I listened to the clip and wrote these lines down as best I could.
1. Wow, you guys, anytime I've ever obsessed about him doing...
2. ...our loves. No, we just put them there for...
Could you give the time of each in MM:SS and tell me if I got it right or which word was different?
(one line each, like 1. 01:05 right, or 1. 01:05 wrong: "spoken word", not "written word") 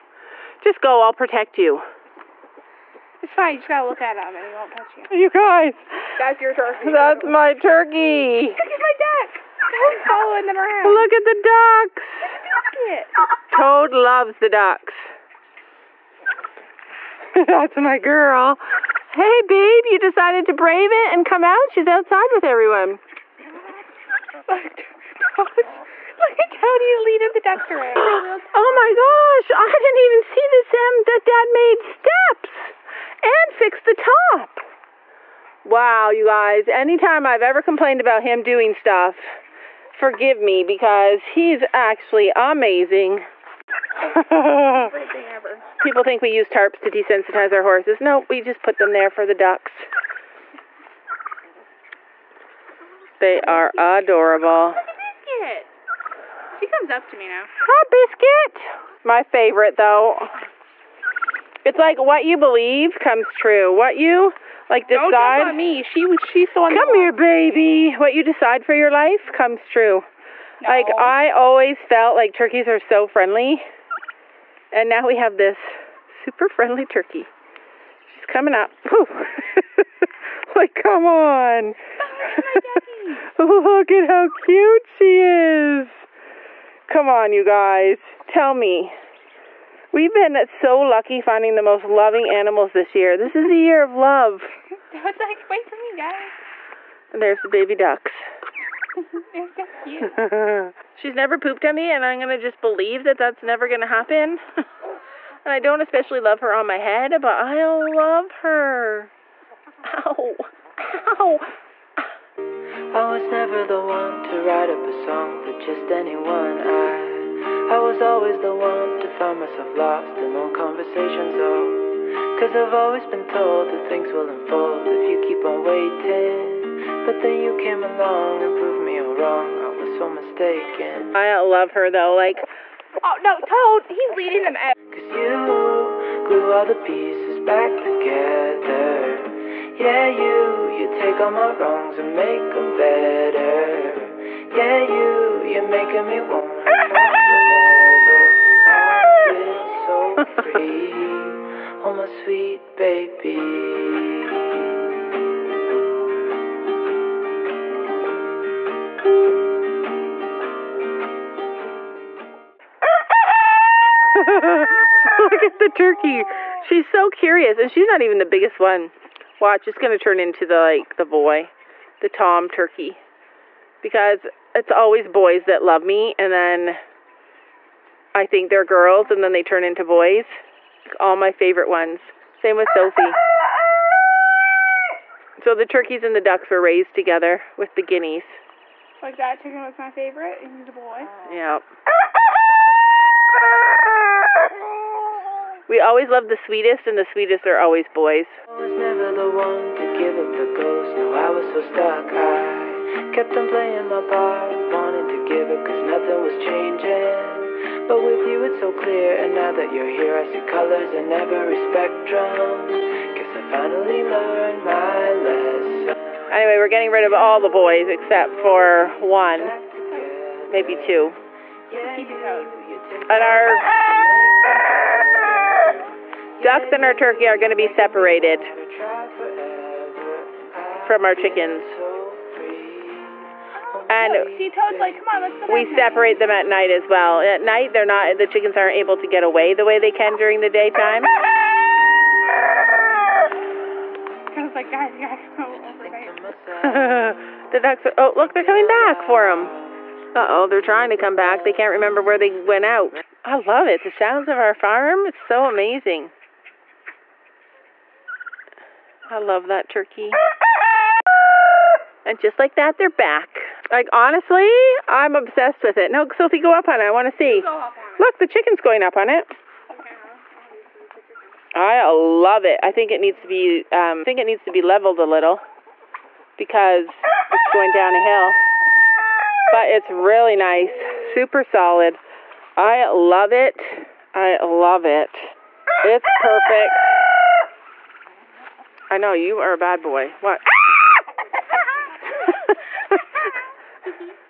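1. 00:35 wrong: "complained", not "obsessed"
2. 00:47 wrong: "horses", not "loves".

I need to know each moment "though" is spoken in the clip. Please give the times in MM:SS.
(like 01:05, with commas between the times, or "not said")
00:59, 02:11.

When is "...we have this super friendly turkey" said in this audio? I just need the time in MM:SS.
01:15.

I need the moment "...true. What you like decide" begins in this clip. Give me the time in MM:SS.
01:03.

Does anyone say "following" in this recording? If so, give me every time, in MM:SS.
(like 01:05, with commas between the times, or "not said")
00:10.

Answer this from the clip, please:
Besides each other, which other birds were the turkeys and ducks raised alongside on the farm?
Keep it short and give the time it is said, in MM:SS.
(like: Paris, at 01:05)
Guineas, at 03:07.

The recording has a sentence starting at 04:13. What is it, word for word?
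The sounds of our farm is so amazing.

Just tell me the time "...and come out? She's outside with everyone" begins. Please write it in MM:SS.
00:21.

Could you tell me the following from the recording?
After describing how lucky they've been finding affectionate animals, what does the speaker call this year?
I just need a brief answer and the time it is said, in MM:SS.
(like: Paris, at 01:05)
A year of love, at 01:33.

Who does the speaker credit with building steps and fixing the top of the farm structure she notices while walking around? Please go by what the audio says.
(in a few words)
Dad.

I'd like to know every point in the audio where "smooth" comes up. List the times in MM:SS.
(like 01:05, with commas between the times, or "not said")
not said.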